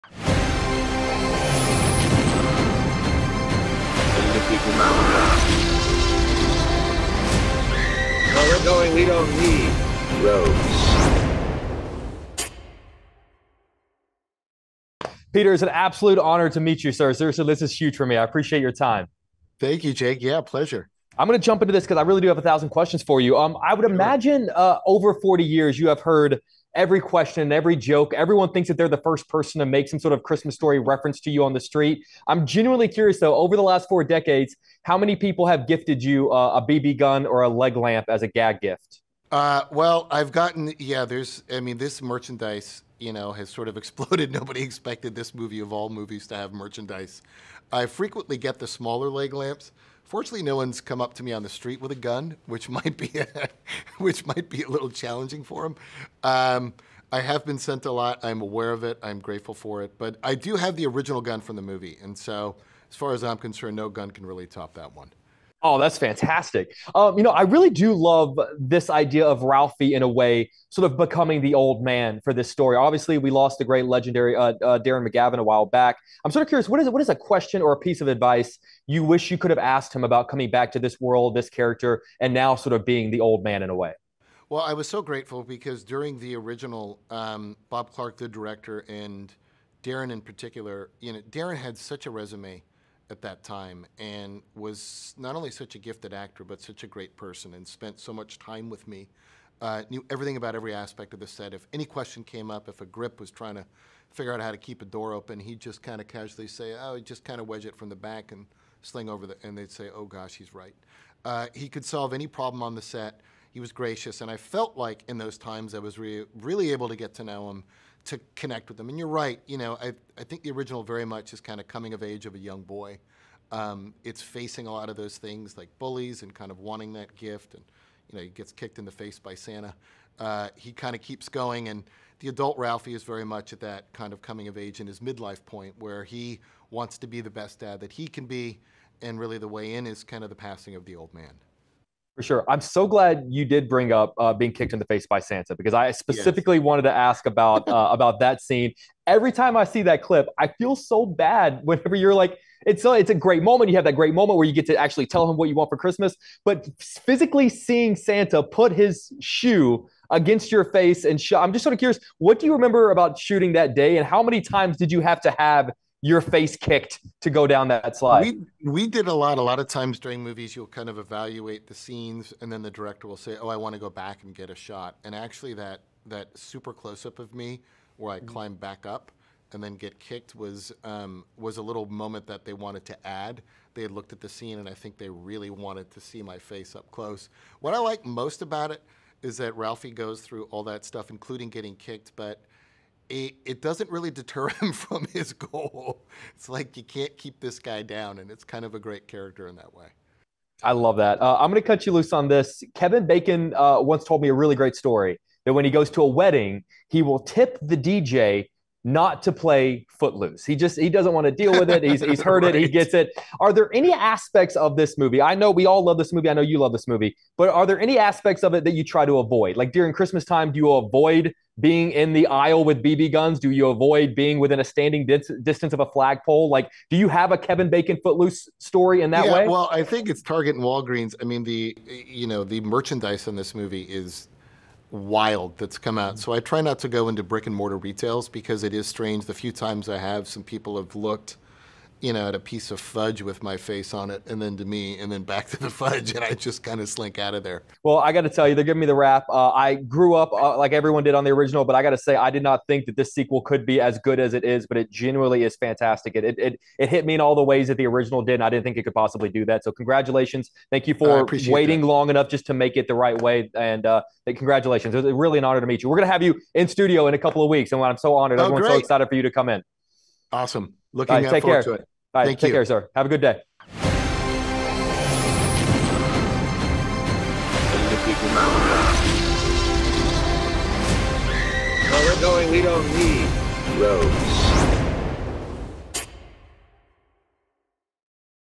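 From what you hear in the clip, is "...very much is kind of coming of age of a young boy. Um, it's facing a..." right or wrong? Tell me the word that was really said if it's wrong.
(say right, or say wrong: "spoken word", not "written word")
right.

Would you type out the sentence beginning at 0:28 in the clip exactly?
Everyone thinks that they're the first person to make some sort of Christmas story reference to you on the street.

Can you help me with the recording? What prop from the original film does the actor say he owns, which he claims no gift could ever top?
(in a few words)
The original gun.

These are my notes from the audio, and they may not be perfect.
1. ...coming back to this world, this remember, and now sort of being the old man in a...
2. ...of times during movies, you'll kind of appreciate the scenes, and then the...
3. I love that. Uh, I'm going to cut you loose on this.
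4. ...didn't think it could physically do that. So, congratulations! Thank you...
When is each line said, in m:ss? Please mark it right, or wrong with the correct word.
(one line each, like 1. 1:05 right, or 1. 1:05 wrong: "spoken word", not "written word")
1. 1:20 wrong: "character", not "remember"
2. 2:49 wrong: "evaluate", not "appreciate"
3. 3:20 right
4. 4:18 wrong: "possibly", not "physically".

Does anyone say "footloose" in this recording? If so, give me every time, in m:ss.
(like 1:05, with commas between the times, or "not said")
3:29, 3:48.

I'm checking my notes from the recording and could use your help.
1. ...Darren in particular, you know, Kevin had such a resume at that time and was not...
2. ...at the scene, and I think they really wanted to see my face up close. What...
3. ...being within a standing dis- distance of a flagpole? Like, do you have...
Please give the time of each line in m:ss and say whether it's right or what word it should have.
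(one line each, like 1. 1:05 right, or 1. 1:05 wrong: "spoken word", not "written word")
1. 1:29 wrong: "Darren", not "Kevin"
2. 3:04 right
3. 3:44 right.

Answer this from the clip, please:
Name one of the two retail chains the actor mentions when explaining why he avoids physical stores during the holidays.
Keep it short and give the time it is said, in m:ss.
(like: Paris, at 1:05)
Target, at 3:50.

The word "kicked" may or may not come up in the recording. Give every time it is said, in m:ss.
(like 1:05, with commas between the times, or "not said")
2:08, 2:24, 2:46, 2:59, 3:11.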